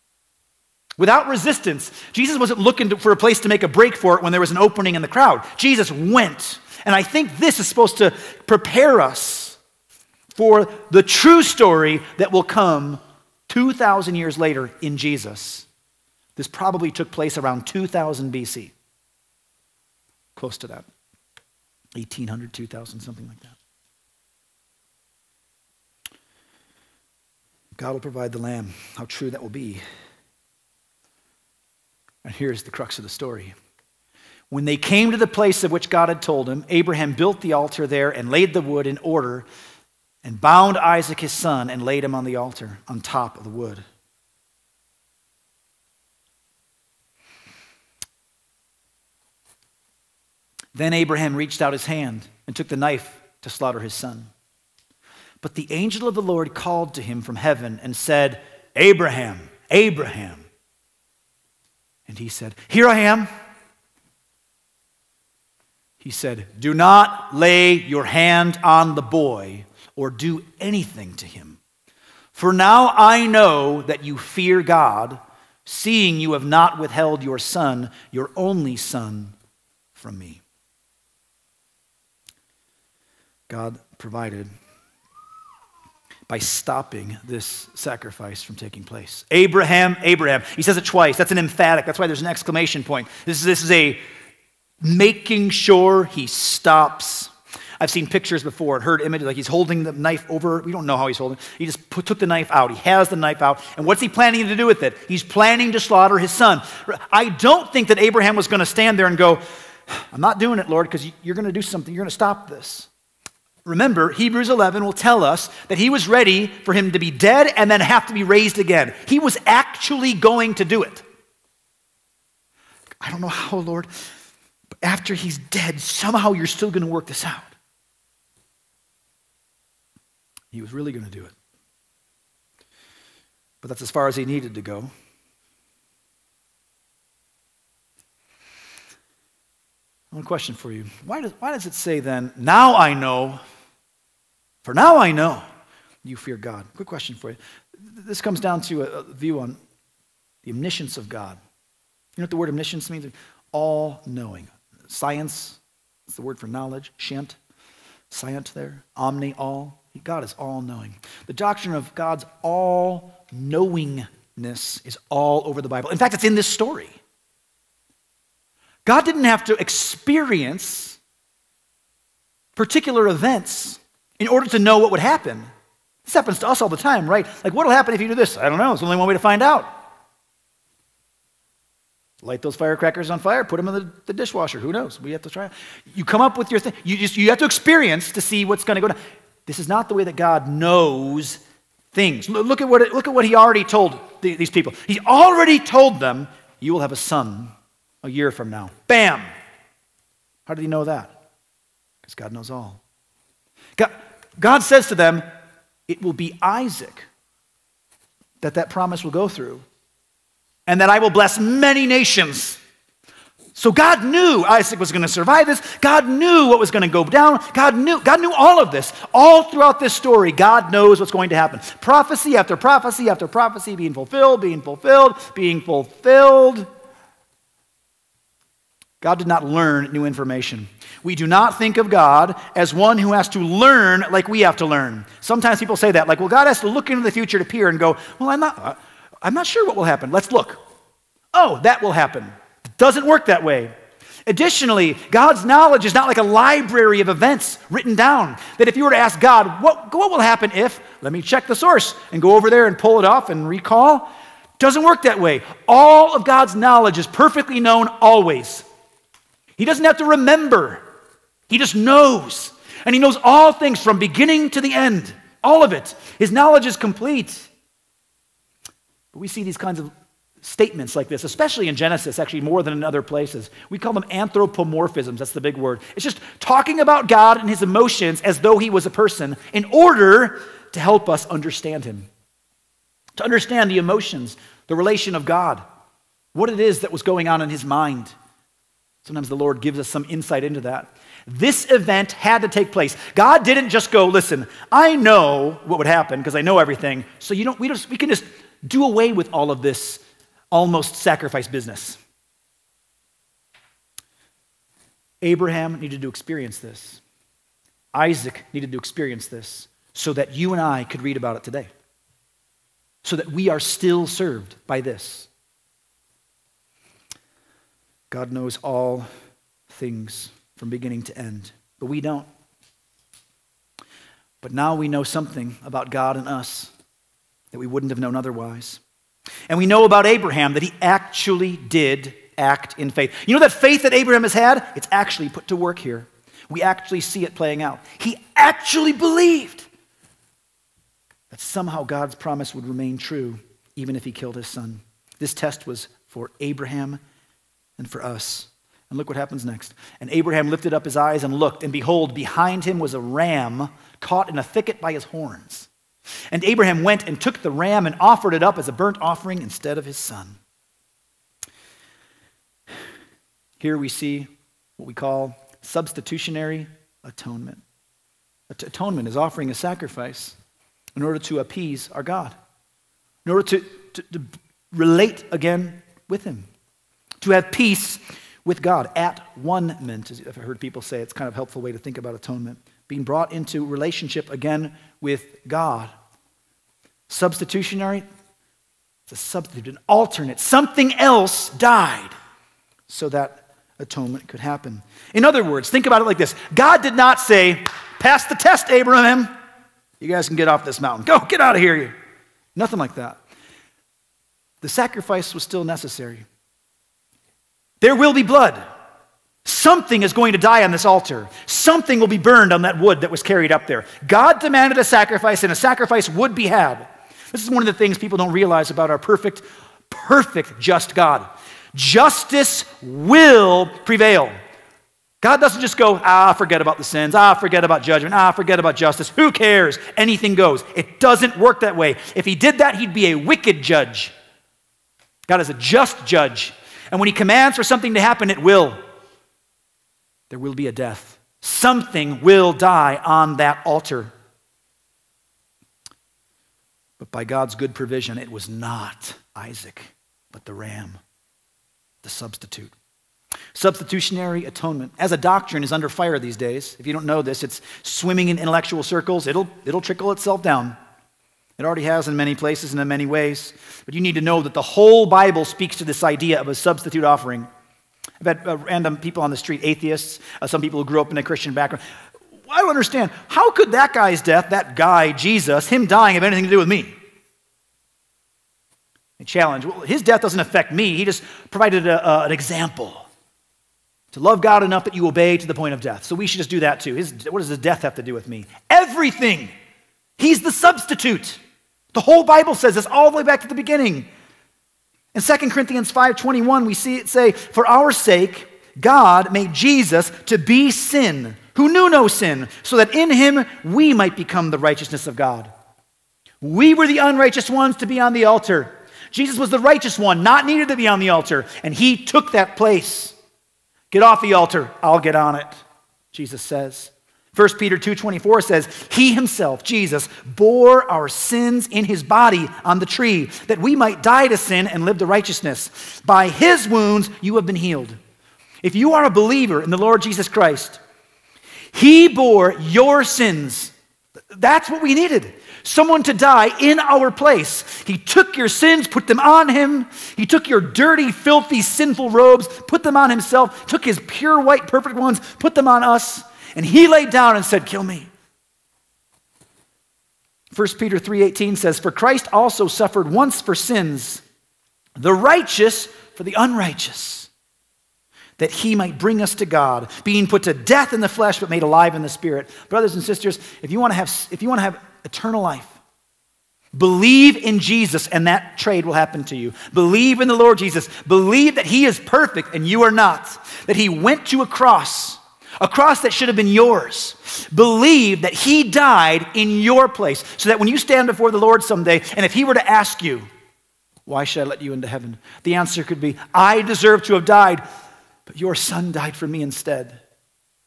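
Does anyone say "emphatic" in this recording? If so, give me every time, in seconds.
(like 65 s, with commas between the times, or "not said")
91 s.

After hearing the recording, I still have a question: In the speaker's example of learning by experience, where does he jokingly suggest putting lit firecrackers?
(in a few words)
the dishwasher.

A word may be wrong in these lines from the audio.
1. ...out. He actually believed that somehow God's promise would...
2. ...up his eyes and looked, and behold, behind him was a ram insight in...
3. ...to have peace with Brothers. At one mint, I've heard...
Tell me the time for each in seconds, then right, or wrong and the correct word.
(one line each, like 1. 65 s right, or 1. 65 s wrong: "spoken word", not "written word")
1. 337 s right
2. 350 s wrong: "caught", not "insight"
3. 377 s wrong: "God", not "Brothers".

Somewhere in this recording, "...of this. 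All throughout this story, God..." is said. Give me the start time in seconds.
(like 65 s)
218 s.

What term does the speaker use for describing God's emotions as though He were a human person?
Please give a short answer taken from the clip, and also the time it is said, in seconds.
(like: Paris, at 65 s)
anthropomorphisms, at 274 s.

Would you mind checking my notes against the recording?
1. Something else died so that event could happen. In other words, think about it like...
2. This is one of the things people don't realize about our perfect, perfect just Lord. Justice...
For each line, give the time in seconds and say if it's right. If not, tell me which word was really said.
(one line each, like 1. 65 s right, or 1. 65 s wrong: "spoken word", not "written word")
1. 390 s wrong: "atonement", not "event"
2. 417 s wrong: "God", not "Lord".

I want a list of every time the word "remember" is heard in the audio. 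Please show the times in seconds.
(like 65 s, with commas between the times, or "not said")
113 s, 260 s.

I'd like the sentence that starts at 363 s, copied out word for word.
Here we see what we call substitutionary atonement.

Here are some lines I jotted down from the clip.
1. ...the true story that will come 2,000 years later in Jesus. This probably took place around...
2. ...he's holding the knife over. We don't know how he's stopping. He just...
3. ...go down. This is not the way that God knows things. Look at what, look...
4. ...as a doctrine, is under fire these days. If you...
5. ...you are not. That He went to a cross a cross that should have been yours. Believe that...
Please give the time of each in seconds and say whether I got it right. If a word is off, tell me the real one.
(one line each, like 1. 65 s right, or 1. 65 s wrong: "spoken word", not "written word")
1. 10 s right
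2. 99 s wrong: "holding", not "stopping"
3. 188 s right
4. 454 s right
5. 572 s right.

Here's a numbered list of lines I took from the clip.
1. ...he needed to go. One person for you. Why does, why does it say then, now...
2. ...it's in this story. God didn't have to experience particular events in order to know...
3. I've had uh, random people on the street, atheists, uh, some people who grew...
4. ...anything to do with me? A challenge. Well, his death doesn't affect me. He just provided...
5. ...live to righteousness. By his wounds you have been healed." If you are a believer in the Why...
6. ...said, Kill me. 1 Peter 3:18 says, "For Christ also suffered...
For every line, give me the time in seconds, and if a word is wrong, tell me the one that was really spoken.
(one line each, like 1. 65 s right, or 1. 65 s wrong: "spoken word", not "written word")
1. 134 s wrong: "question", not "person"
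2. 166 s right
3. 468 s right
4. 476 s right
5. 524 s wrong: "Lord", not "Why"
6. 547 s right.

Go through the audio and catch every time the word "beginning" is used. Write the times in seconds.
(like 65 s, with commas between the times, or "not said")
263 s, 320 s, 493 s.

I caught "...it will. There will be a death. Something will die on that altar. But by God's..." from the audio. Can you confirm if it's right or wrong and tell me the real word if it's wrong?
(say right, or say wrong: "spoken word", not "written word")
right.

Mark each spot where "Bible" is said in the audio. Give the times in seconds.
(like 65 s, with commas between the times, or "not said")
165 s, 465 s, 492 s.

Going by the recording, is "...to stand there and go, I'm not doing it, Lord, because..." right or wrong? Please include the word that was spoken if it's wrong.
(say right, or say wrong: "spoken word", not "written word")
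right.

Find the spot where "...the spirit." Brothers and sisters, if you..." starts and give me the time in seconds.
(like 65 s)
562 s.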